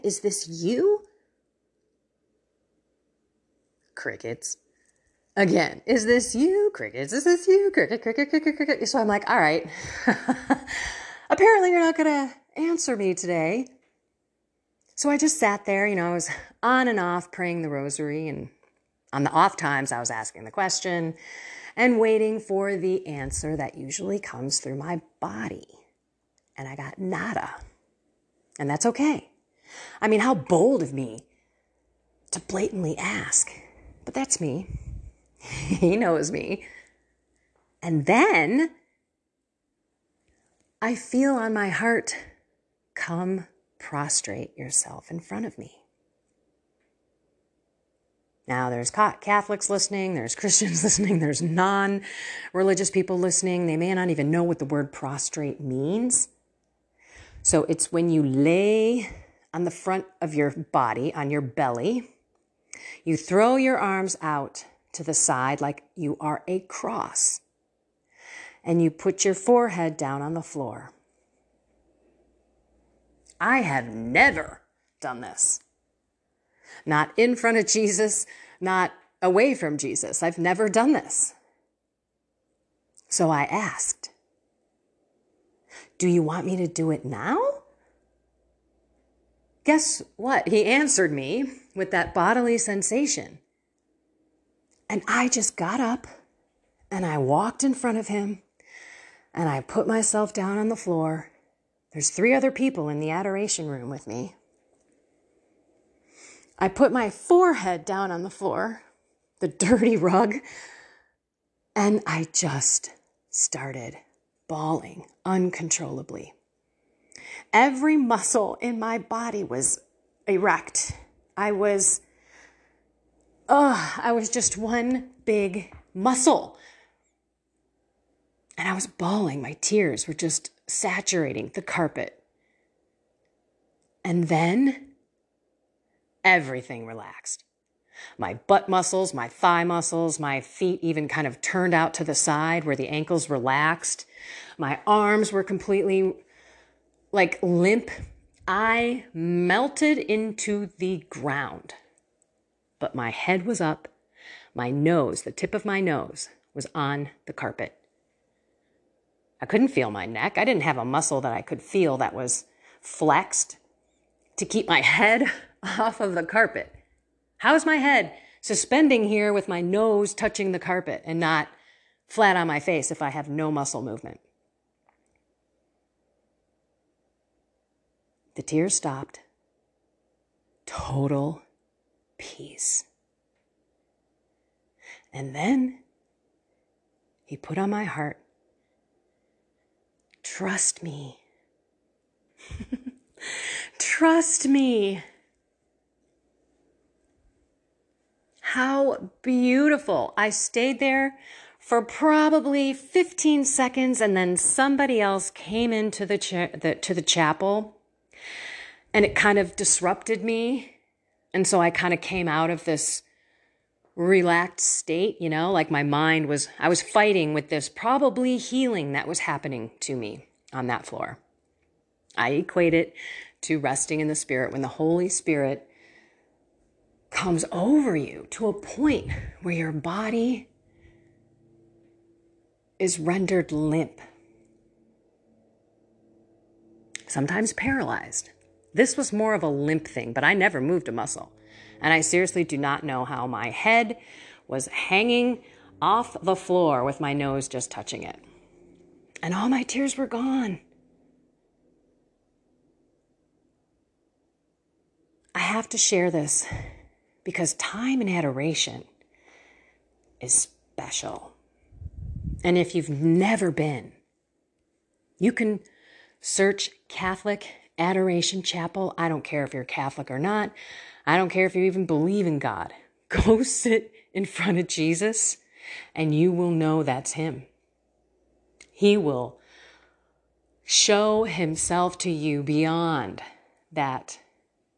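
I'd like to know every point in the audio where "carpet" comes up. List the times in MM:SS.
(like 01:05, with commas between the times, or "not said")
02:11, 02:37, 02:46, 02:50.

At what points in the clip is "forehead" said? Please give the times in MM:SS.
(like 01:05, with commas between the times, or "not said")
01:09, 01:47.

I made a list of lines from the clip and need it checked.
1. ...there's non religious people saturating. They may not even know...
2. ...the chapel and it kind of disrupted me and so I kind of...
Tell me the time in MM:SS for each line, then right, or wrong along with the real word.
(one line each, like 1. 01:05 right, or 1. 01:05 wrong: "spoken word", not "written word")
1. 00:51 wrong: "listening", not "saturating"
2. 03:26 right.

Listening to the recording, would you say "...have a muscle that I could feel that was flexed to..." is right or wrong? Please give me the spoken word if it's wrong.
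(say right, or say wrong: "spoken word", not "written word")
right.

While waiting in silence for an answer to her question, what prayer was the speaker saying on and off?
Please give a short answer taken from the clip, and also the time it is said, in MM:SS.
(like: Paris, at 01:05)
the rosary, at 00:17.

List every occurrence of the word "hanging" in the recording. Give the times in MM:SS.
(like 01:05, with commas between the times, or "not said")
04:04.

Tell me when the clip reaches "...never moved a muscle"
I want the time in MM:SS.
04:00.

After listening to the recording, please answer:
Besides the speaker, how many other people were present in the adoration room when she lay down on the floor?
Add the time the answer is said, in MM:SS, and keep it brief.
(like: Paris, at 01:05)
3, at 01:42.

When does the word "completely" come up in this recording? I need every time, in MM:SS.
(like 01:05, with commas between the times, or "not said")
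02:25.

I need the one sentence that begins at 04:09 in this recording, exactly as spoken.
And all my tears were gone.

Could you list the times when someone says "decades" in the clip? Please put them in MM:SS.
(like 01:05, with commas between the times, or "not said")
not said.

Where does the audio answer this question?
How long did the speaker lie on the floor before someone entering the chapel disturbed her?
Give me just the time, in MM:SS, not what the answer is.
03:22.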